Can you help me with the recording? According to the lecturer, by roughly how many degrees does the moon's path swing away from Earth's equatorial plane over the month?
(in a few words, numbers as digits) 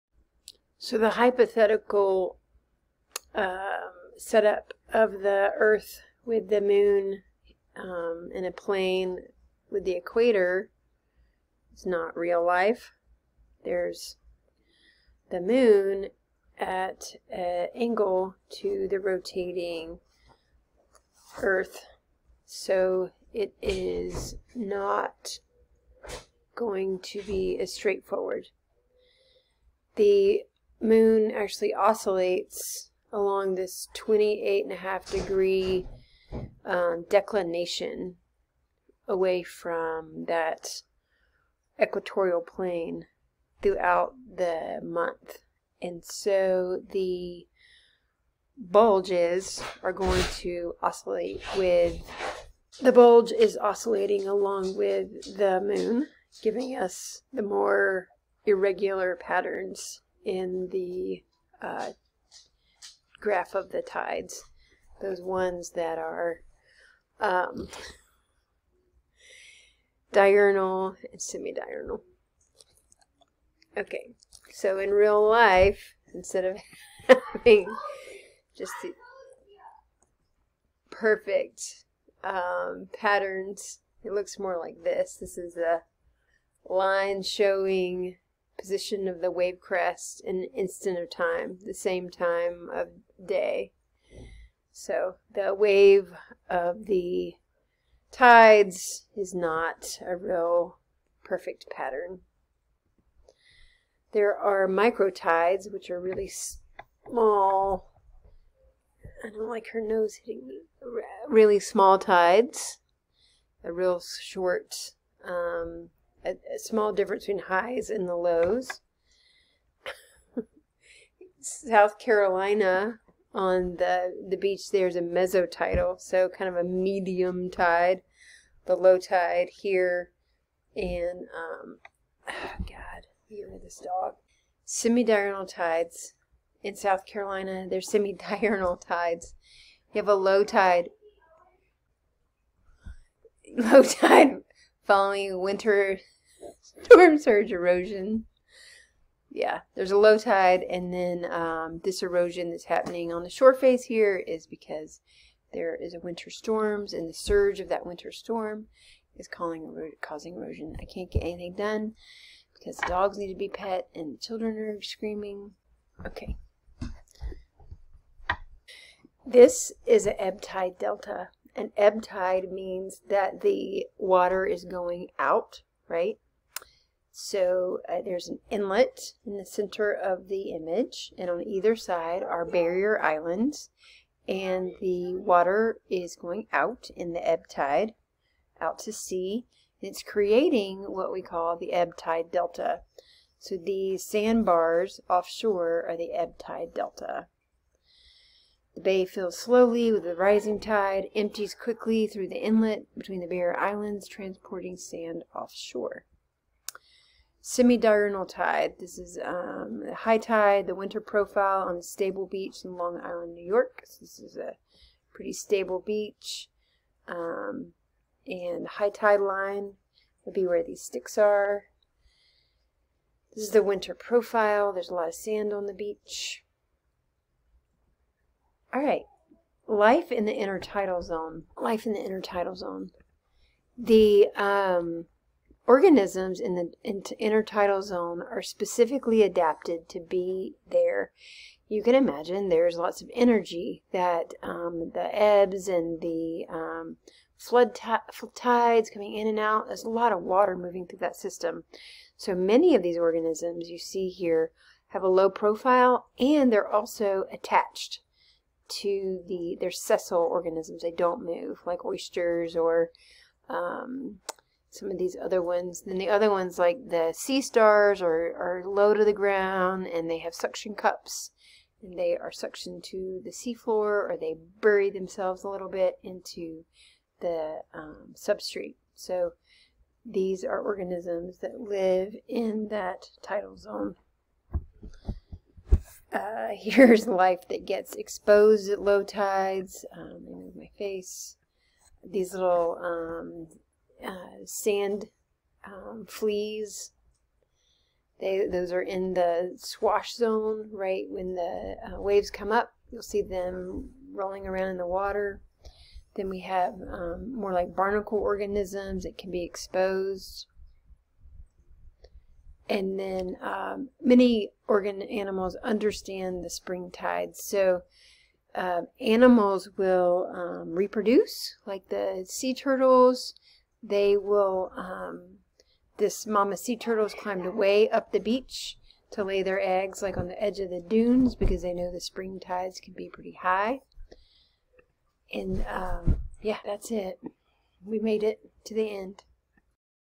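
28.5 degrees.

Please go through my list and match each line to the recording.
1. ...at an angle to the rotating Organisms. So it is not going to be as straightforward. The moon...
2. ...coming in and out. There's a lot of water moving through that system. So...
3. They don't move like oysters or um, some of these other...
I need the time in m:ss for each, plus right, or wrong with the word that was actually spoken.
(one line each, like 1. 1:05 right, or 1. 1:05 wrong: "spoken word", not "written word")
1. 0:16 wrong: "Earth", not "Organisms"
2. 4:08 right
3. 4:20 right.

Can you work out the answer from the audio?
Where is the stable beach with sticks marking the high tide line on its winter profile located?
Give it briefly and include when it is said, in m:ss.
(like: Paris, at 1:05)
Long Island, New York, at 3:32.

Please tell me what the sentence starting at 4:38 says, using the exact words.
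So these are organisms that live in that tidal zone.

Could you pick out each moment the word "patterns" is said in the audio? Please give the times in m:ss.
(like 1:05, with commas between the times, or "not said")
0:59, 1:22, 1:41.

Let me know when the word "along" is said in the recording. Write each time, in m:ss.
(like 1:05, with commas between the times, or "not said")
0:33, 0:54.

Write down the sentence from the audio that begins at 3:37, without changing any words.
Um, and high tide line would be where these sticks are.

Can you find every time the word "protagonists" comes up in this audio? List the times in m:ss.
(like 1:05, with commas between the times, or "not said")
not said.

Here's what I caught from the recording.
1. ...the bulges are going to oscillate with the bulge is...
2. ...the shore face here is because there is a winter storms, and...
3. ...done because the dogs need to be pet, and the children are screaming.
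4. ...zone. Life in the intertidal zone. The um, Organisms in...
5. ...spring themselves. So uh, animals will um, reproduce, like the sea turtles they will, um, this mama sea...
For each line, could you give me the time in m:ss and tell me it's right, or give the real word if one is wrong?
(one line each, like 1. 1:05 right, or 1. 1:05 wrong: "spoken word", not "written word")
1. 0:46 right
2. 2:33 right
3. 2:41 right
4. 3:51 right
5. 5:16 wrong: "tides", not "themselves".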